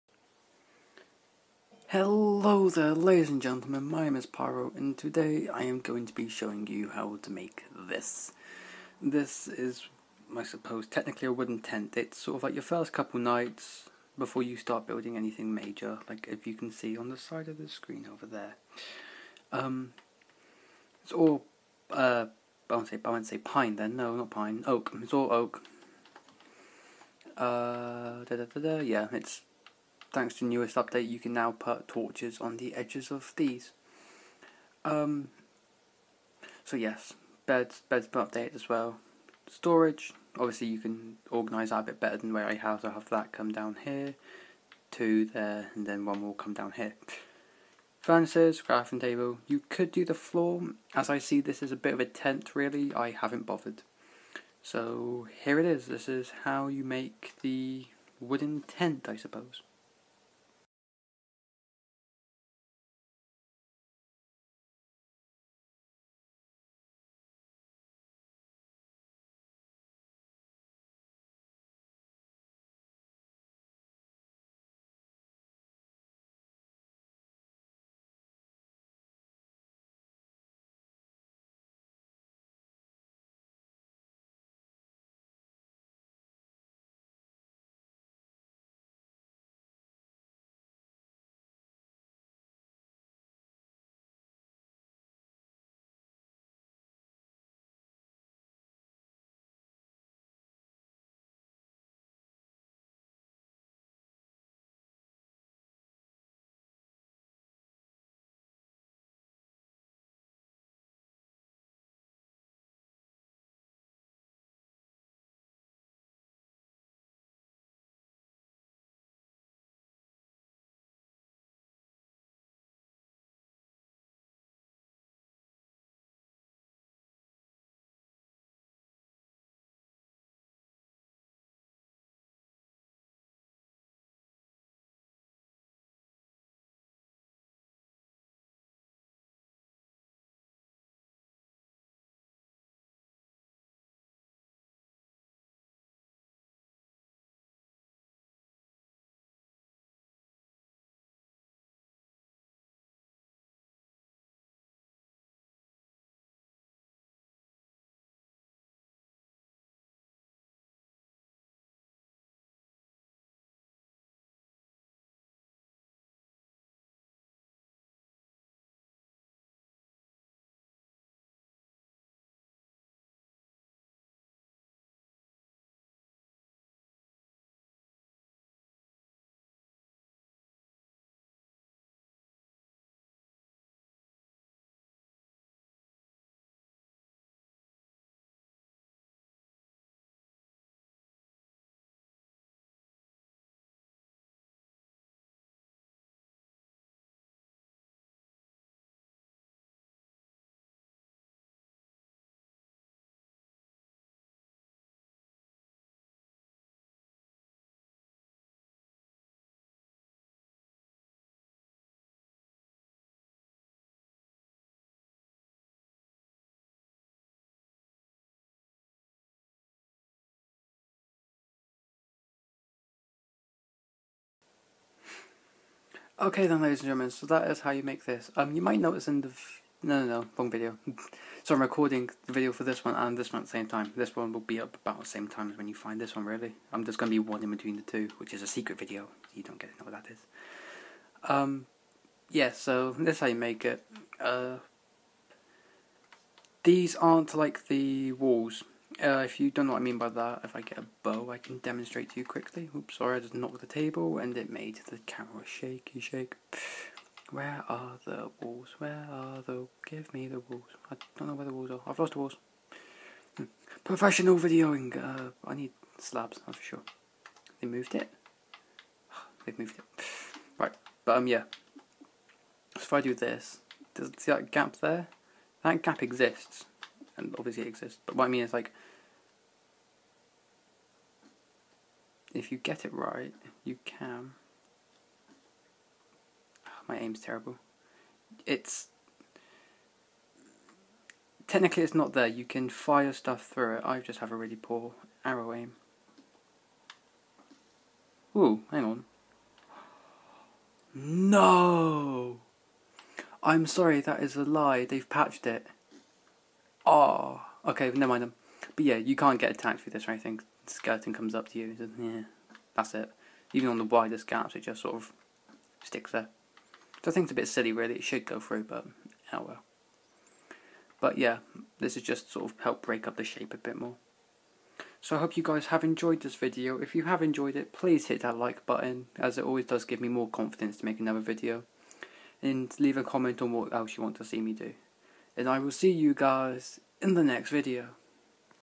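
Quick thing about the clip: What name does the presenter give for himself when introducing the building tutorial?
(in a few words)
Pyro.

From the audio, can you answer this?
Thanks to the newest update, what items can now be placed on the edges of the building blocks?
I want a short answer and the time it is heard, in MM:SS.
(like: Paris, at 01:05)
torches, at 00:31.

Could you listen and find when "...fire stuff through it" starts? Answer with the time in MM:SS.
04:52.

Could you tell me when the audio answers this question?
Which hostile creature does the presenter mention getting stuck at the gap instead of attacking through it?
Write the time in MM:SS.
05:10.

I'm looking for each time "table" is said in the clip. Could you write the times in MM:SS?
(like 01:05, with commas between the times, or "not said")
00:48, 04:13.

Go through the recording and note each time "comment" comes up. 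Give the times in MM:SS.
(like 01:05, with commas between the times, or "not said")
05:33.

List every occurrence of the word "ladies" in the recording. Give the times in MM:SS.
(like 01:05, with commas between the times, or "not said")
00:02, 03:46.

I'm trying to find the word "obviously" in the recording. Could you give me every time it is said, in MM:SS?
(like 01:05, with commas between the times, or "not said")
00:40, 04:37.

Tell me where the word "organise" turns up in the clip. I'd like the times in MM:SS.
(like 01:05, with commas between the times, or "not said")
00:41.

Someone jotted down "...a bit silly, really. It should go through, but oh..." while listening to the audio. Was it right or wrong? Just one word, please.
right.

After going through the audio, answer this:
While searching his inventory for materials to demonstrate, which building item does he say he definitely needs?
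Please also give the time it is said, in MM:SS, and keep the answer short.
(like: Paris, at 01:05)
slabs, at 04:25.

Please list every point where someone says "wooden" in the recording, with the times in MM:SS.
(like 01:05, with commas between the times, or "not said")
00:11, 00:58.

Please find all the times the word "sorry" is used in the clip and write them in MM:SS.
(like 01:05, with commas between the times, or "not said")
04:12, 05:03.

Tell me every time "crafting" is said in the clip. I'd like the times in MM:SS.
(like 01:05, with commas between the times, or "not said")
00:48.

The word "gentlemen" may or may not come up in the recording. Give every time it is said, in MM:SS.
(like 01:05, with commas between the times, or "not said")
00:03, 03:46.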